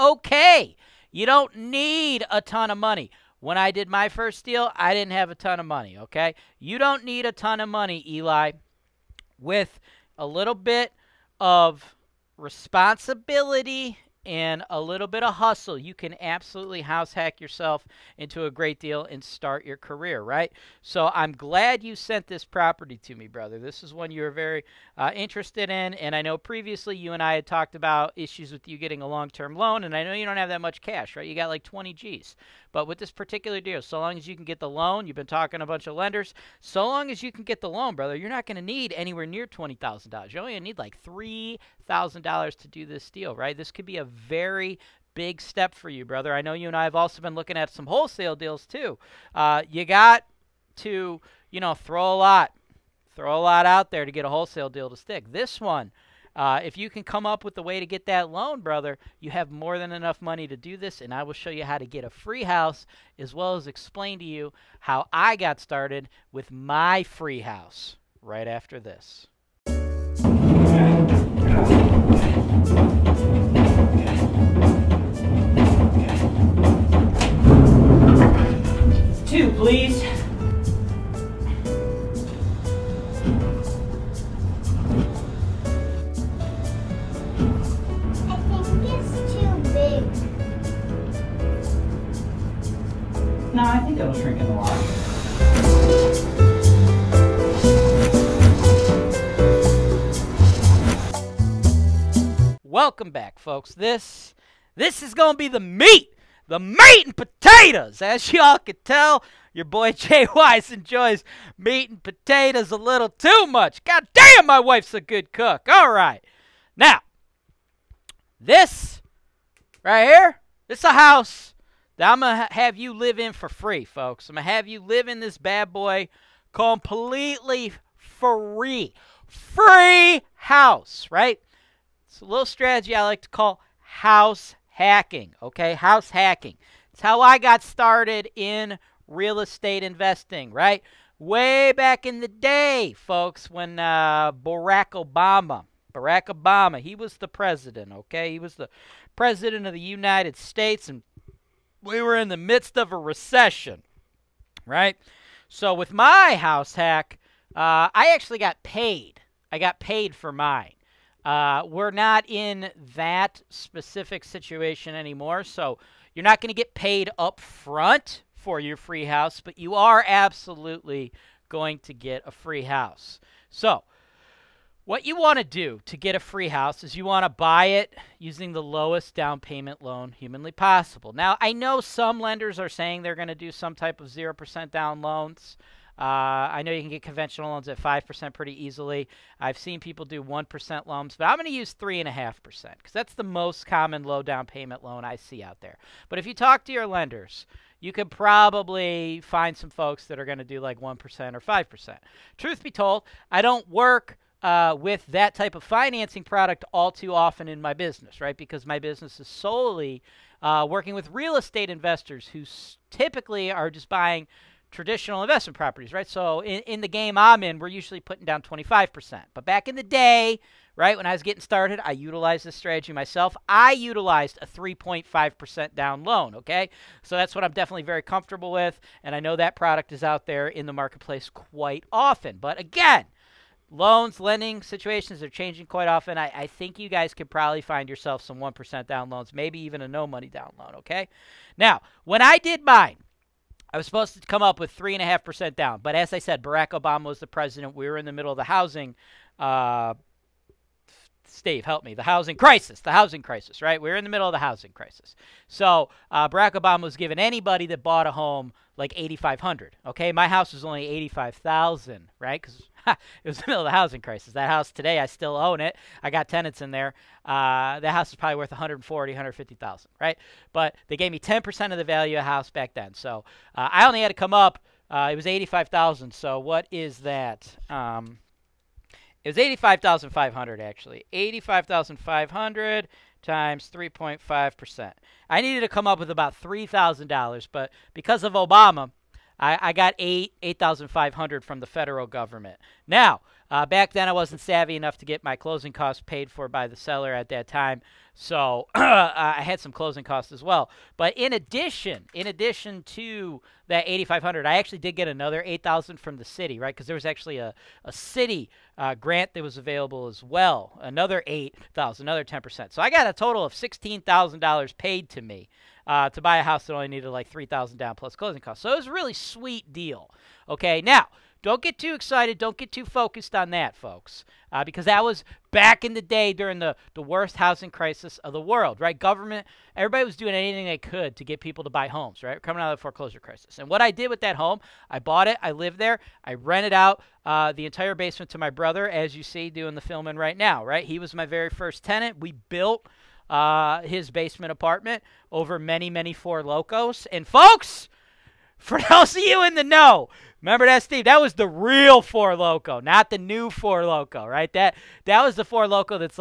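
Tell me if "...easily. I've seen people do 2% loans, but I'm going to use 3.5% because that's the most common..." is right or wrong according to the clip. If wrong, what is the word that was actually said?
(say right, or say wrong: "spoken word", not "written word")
wrong: "1", not "2".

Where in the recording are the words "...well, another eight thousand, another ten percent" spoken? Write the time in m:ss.
5:10.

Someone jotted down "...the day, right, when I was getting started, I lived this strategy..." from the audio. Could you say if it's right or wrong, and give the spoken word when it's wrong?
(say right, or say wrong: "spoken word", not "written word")
wrong: "utilized", not "lived".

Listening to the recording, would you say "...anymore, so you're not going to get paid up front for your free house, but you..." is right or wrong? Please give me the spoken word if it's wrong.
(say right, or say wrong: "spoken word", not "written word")
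right.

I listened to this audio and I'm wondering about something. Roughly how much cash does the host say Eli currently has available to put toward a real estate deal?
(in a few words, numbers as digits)
20 G's.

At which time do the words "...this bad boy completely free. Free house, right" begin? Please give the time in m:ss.
2:05.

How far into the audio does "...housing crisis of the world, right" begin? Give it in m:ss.
5:27.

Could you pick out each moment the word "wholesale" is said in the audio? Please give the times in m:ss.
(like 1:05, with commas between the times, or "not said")
0:47, 0:54.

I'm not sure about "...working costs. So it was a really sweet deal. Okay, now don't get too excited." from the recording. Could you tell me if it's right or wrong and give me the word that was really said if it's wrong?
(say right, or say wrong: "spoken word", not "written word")
wrong: "closing", not "working".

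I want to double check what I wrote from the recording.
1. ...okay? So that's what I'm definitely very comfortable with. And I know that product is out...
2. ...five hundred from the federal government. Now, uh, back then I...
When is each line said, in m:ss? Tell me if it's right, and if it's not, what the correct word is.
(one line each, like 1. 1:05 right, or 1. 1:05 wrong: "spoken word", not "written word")
1. 3:46 right
2. 4:50 right.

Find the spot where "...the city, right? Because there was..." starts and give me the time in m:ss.
5:06.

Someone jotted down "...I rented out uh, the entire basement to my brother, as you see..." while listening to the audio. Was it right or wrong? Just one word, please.
right.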